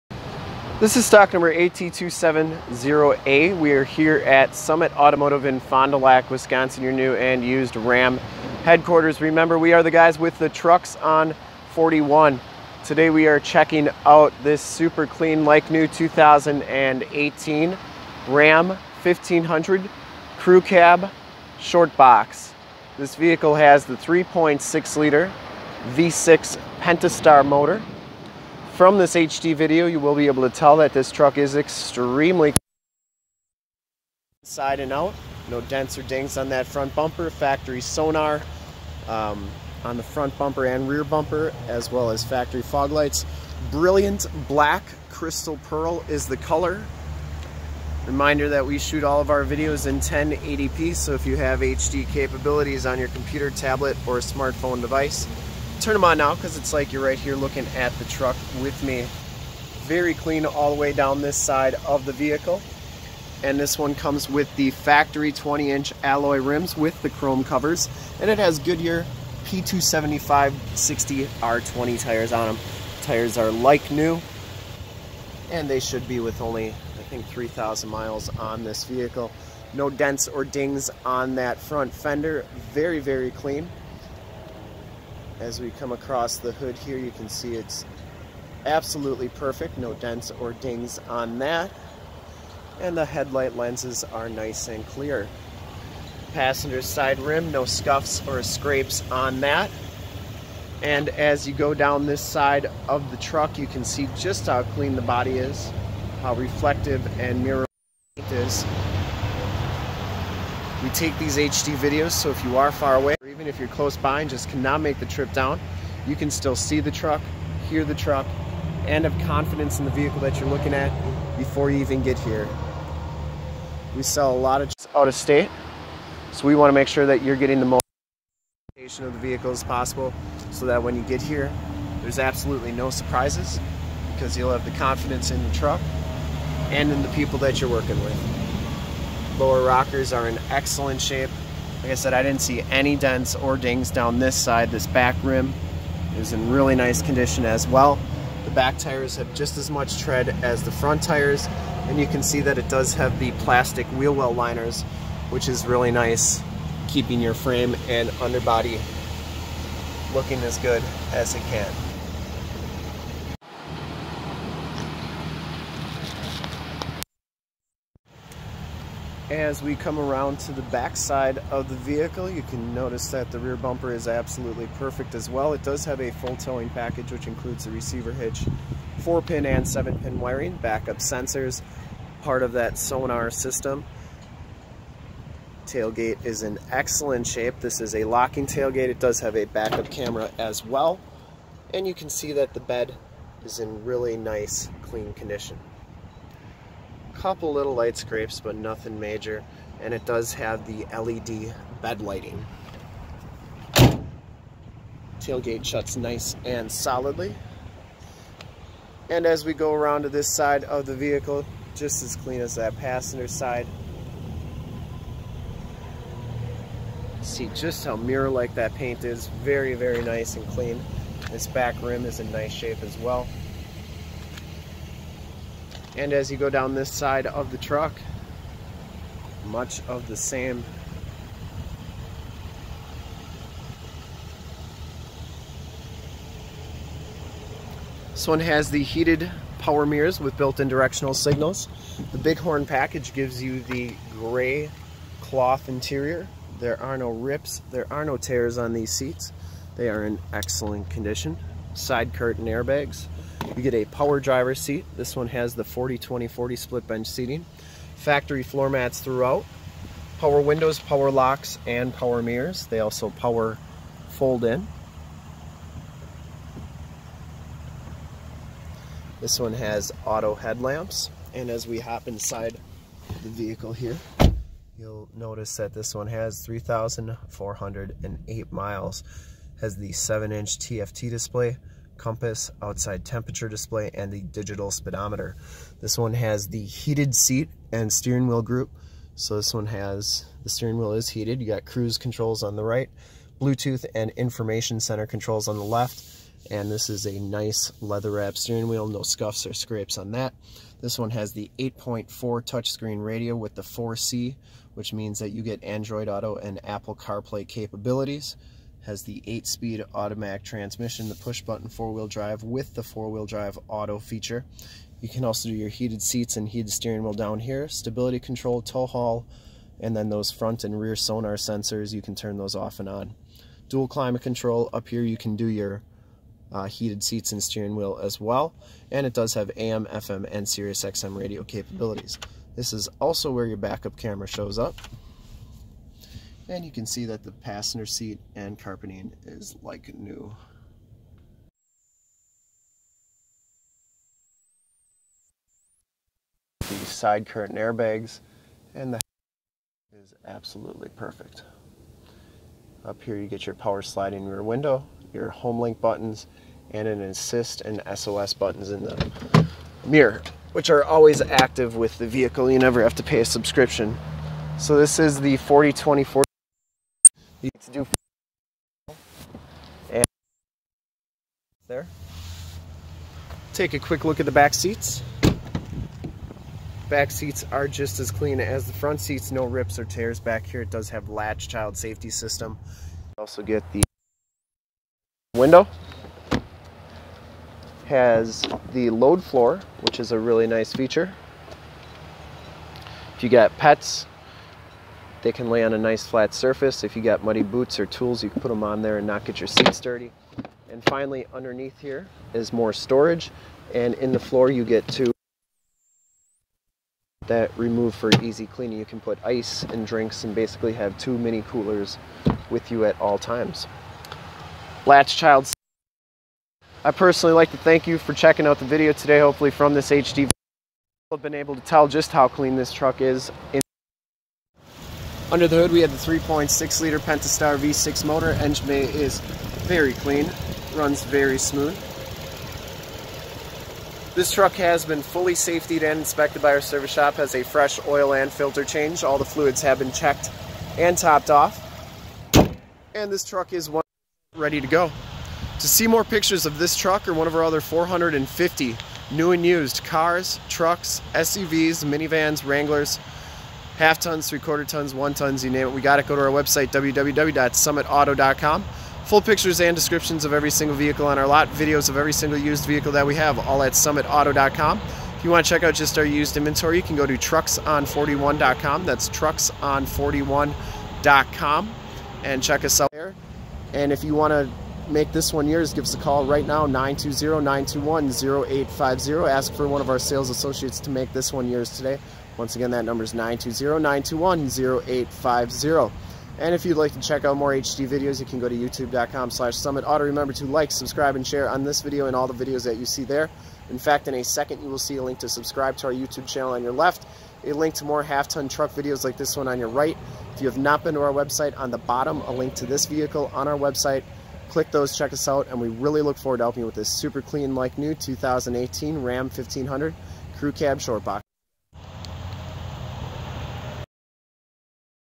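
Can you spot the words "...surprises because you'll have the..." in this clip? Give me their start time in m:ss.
2:12.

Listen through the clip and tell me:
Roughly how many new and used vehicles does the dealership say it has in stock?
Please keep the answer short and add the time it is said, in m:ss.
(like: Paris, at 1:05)
450, at 7:27.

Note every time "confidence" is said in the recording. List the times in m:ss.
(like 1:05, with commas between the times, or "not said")
1:59, 2:14.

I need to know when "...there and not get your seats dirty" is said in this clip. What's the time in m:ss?
6:38.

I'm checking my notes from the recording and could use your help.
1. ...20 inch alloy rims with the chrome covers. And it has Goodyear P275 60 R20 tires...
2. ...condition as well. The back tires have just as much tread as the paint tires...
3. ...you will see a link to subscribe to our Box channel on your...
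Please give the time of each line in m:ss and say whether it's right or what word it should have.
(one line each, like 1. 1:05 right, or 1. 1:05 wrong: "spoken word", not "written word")
1. 1:05 right
2. 2:27 wrong: "front", not "paint"
3. 8:14 wrong: "YouTube", not "Box".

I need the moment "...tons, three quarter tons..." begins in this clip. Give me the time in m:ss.
7:33.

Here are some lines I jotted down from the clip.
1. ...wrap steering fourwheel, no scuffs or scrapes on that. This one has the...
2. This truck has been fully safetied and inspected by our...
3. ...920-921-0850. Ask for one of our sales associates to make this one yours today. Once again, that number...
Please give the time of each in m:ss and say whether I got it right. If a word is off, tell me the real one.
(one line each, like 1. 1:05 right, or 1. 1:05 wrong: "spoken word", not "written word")
1. 4:58 wrong: "wheel", not "fourwheel"
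2. 7:14 right
3. 7:56 right.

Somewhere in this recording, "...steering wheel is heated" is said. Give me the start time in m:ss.
4:50.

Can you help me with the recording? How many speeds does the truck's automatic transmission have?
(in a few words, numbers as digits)
8.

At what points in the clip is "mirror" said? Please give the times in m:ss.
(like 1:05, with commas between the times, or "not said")
1:47, 3:37, 3:59, 4:22, 5:59.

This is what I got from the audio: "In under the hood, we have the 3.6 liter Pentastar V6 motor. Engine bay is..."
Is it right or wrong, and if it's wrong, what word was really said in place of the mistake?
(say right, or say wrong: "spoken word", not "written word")
right.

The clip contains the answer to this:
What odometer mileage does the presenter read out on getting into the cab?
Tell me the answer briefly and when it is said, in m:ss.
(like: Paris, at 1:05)
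3,408, at 4:36.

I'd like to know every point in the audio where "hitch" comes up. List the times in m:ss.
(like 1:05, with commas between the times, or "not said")
2:58.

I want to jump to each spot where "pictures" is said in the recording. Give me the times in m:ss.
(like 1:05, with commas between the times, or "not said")
7:26, 7:39.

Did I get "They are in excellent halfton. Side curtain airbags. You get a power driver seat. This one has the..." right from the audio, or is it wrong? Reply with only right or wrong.
wrong.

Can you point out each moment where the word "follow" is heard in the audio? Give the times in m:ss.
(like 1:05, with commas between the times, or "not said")
not said.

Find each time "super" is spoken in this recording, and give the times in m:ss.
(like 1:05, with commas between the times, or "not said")
0:14, 8:26.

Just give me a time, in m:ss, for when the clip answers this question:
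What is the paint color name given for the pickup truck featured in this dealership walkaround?
0:43.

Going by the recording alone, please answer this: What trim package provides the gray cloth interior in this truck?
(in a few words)
Bighorn.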